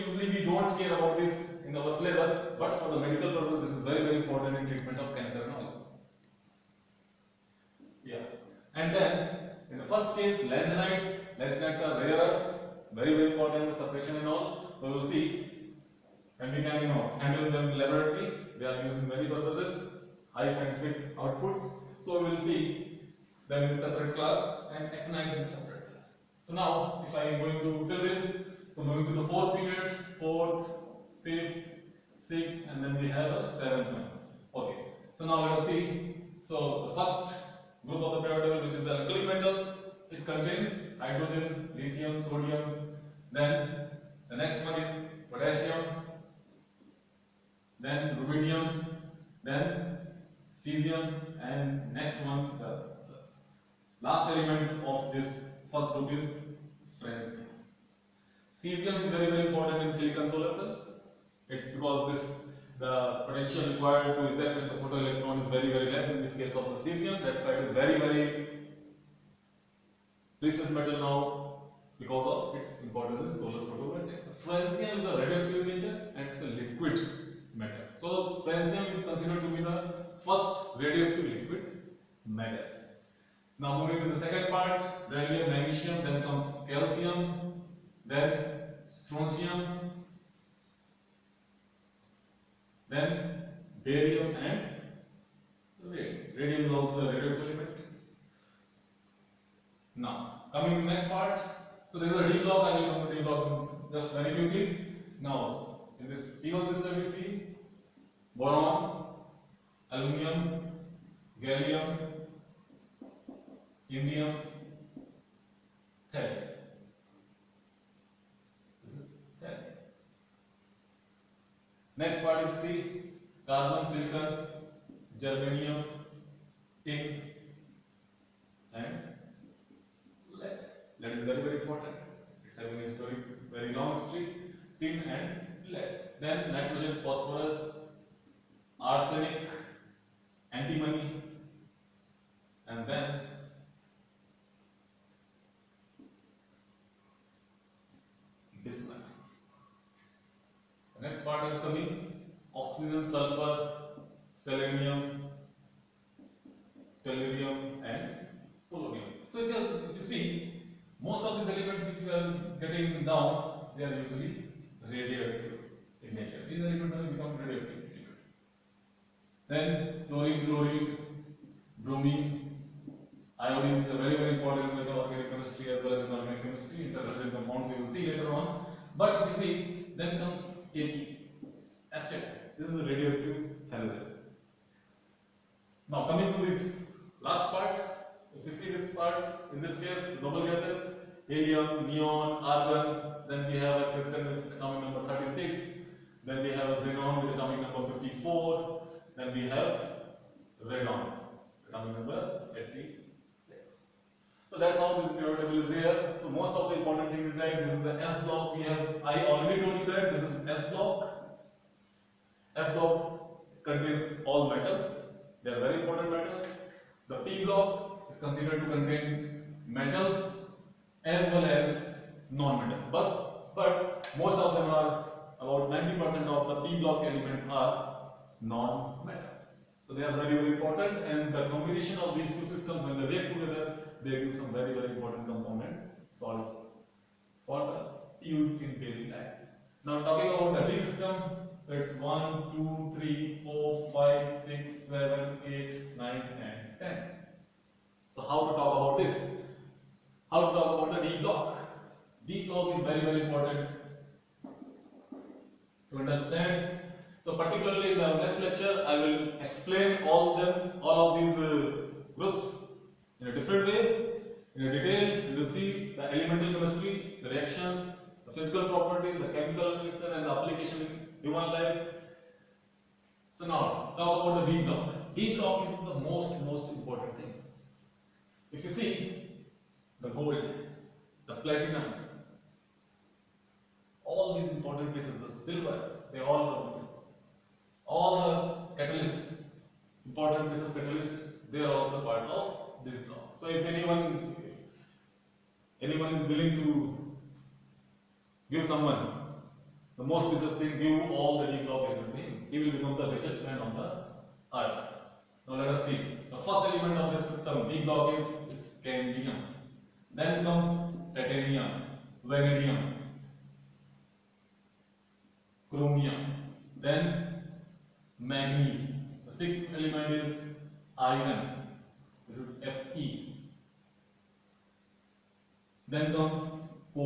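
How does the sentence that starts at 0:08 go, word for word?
And then in the first case, lanthanides.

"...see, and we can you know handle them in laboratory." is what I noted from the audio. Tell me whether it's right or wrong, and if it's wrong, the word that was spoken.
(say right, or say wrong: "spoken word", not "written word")
right.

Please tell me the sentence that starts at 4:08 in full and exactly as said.
So how to talk about this?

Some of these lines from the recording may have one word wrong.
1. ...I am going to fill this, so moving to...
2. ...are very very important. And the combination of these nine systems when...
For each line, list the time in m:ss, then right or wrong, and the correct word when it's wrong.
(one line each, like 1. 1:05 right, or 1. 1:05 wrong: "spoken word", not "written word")
1. 0:27 right
2. 3:50 wrong: "two", not "nine".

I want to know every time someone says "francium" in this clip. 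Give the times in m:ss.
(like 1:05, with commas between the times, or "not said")
0:57, 1:14, 1:18.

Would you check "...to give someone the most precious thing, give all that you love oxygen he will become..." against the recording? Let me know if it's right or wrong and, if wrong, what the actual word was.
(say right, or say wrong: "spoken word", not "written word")
wrong: "given", not "oxygen".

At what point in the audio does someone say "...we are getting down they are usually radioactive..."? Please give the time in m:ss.
2:42.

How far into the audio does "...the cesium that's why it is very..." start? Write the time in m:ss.
1:06.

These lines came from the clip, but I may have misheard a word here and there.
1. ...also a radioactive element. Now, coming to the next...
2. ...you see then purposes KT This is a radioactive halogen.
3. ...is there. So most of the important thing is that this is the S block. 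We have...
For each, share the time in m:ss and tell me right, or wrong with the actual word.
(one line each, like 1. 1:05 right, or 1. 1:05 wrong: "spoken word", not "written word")
1. 1:36 right
2. 2:59 wrong: "comes", not "purposes"
3. 3:25 right.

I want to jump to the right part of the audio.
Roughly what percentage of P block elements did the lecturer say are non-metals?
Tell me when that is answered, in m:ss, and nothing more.
3:45.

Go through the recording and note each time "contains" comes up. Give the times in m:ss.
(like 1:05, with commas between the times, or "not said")
0:40, 3:33, 3:38.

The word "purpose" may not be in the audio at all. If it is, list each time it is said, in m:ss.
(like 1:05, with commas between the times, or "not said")
0:03, 0:19.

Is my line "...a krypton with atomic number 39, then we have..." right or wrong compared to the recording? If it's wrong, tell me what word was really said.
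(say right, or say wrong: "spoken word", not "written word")
wrong: "36", not "39".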